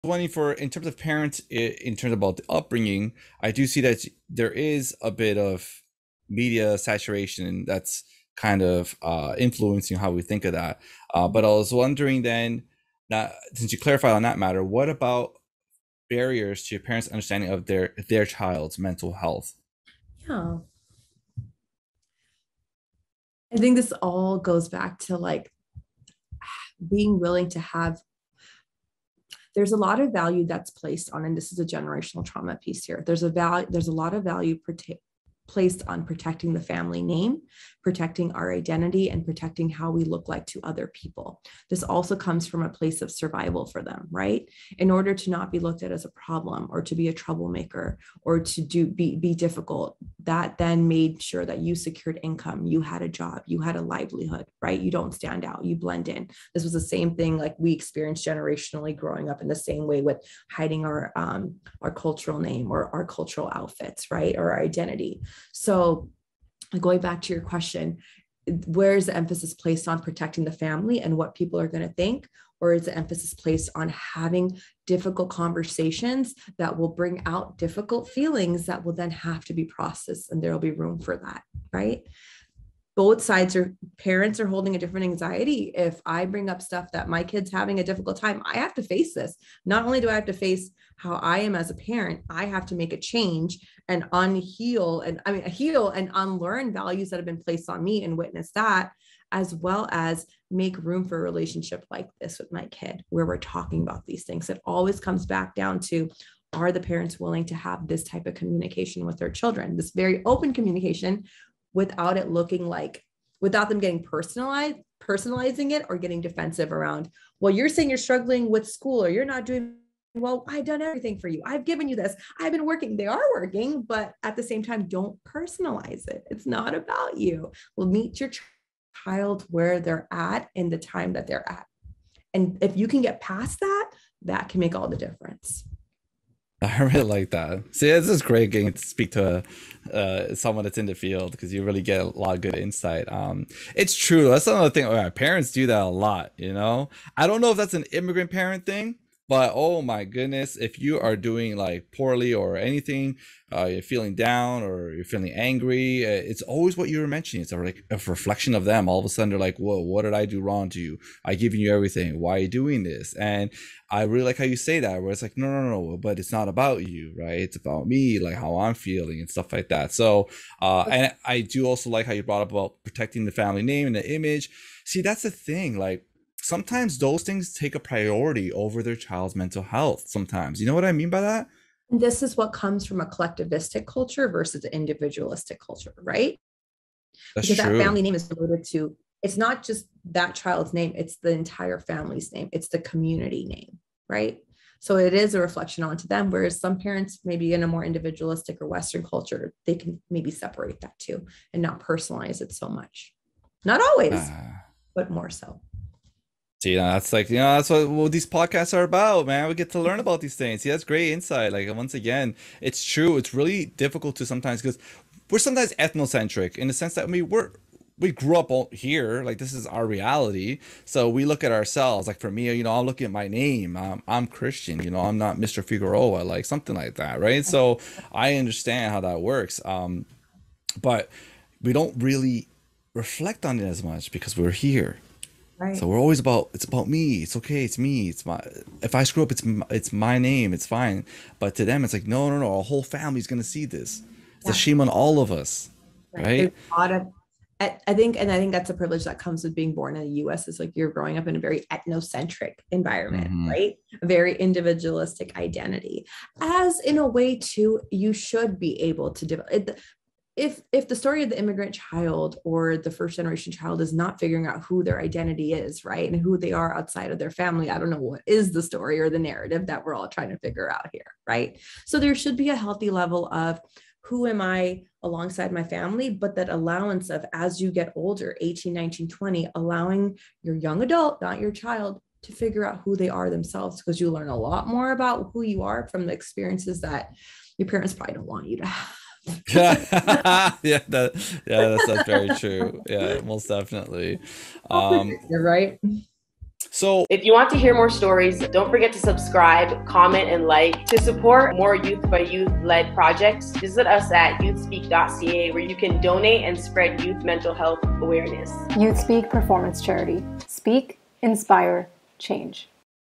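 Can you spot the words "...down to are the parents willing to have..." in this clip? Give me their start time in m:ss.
1:45.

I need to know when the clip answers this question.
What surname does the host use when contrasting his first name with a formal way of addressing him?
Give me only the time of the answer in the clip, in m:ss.
3:45.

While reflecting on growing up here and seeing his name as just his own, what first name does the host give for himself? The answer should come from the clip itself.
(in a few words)
Christian.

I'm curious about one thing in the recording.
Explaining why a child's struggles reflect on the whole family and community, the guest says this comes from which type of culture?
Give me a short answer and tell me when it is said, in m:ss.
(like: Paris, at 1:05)
collectivistic, at 3:03.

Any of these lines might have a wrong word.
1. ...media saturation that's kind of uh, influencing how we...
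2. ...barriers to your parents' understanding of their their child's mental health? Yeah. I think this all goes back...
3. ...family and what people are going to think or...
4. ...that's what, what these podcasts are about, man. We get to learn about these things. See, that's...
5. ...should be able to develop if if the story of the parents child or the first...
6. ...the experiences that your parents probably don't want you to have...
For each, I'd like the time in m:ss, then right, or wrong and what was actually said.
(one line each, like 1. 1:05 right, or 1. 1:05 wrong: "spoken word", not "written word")
1. 0:06 right
2. 0:16 right
3. 1:10 right
4. 3:27 right
5. 4:18 wrong: "immigrant", not "parents"
6. 4:46 right.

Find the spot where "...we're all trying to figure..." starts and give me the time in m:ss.
4:29.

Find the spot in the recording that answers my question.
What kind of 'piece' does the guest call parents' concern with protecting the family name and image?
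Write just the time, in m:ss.
0:31.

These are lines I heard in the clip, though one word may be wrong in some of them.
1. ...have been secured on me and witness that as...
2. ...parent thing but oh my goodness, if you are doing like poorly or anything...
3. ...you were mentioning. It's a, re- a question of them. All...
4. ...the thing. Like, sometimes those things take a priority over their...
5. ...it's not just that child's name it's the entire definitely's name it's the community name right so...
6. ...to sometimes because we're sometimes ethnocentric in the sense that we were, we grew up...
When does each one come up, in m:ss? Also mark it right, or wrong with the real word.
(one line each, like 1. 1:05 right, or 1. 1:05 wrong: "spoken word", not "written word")
1. 1:37 wrong: "placed", not "secured"
2. 2:28 right
3. 2:36 wrong: "reflection", not "question"
4. 2:55 right
5. 3:09 wrong: "family", not "definitely"
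6. 3:34 right.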